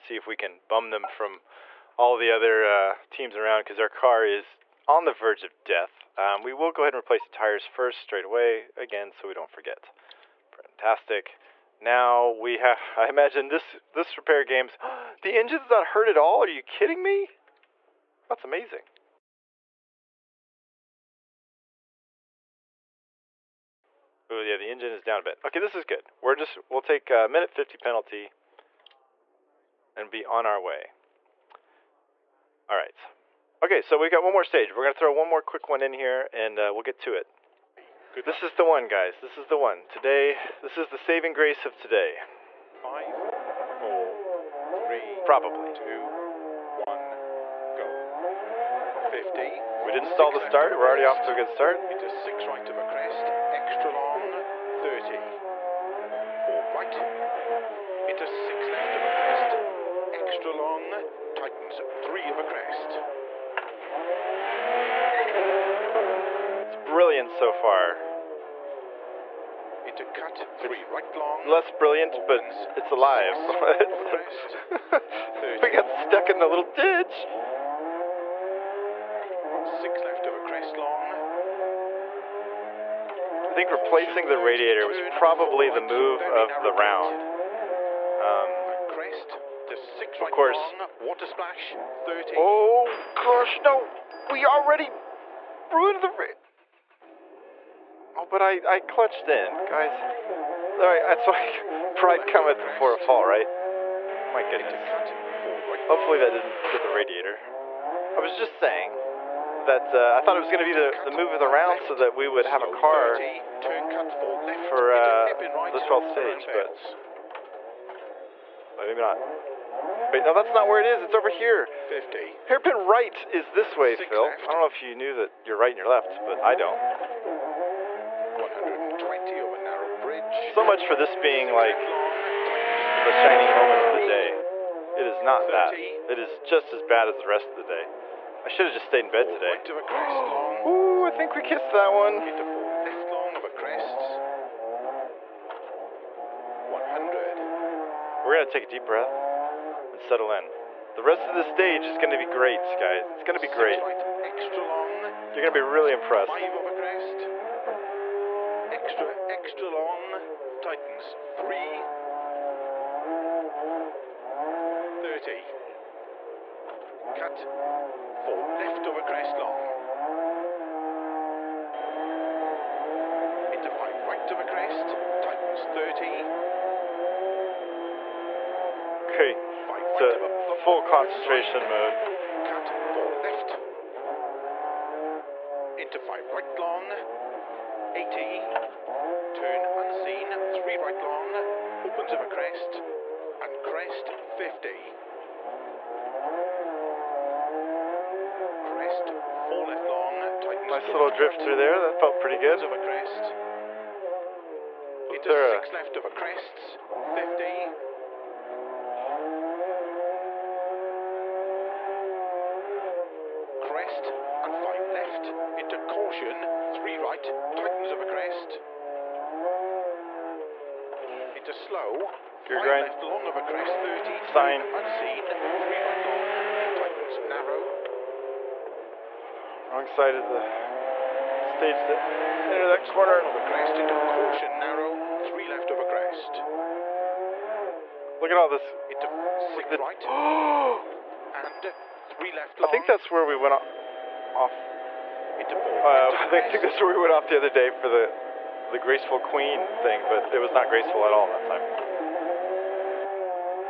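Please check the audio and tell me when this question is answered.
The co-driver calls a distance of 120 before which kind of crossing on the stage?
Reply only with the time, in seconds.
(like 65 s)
129 s.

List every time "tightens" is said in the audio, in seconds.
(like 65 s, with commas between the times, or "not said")
61 s, 160 s, 175 s, 217 s, 226 s.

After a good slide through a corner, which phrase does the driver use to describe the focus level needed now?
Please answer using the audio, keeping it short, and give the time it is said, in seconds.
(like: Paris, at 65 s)
full concentration mode, at 180 s.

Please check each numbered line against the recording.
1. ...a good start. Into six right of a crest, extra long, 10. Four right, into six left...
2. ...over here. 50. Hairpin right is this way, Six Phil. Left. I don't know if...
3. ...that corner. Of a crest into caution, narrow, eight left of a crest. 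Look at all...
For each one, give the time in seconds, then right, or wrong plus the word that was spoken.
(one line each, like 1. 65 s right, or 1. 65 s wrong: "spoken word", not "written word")
1. 51 s wrong: "30", not "10"
2. 121 s right
3. 232 s wrong: "three", not "eight".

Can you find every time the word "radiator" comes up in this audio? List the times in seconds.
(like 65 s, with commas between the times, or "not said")
84 s, 106 s.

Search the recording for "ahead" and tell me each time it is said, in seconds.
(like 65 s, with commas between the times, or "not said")
6 s.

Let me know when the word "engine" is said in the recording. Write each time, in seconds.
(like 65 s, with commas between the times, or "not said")
15 s, 24 s.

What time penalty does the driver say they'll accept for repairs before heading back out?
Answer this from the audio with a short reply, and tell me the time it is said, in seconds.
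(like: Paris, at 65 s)
1 minute 50, at 27 s.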